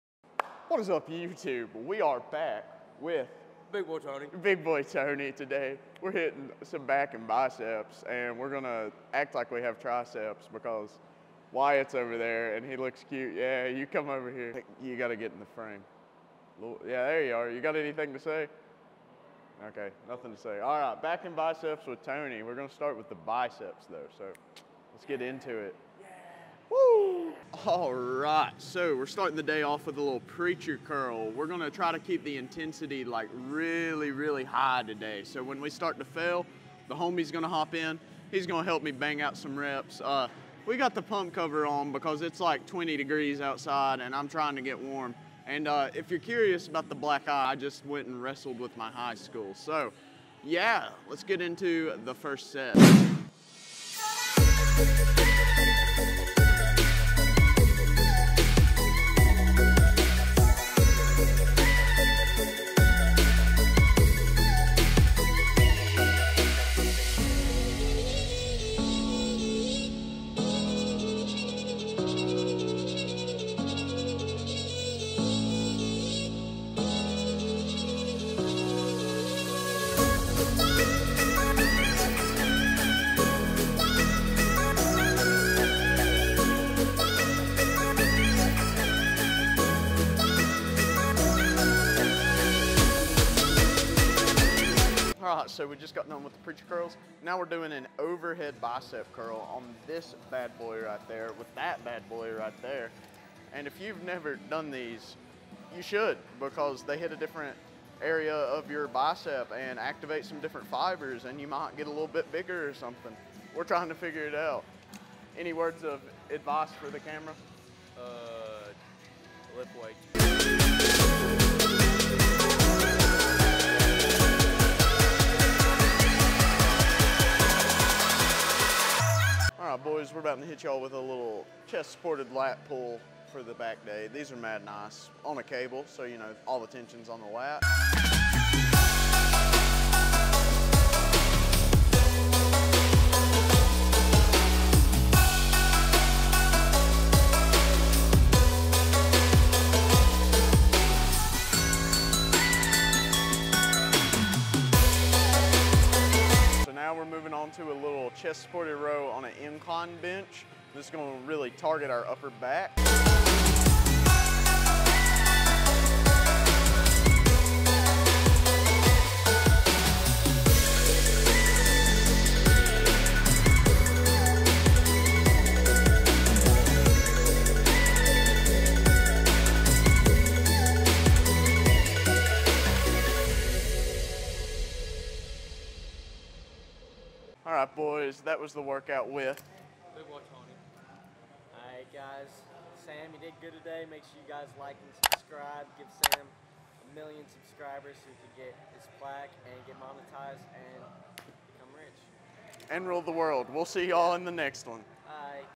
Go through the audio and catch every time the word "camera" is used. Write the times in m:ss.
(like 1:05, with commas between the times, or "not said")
1:56.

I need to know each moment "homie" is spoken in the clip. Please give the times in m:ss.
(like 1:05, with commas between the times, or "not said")
0:36.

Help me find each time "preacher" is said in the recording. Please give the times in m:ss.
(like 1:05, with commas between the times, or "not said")
0:30, 1:36.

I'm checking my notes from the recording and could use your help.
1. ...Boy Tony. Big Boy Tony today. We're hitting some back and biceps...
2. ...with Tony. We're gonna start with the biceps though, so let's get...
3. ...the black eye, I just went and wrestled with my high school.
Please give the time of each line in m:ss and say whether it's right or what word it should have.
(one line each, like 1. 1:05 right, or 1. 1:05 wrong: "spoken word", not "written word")
1. 0:03 right
2. 0:21 right
3. 0:46 right.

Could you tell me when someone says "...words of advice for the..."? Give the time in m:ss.
1:55.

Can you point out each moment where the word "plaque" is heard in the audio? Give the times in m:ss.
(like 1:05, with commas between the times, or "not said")
3:18.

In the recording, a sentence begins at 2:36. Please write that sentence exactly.
So now we're moving on to a little chest supported row on an incline bench.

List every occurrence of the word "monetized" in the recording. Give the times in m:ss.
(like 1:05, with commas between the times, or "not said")
3:19.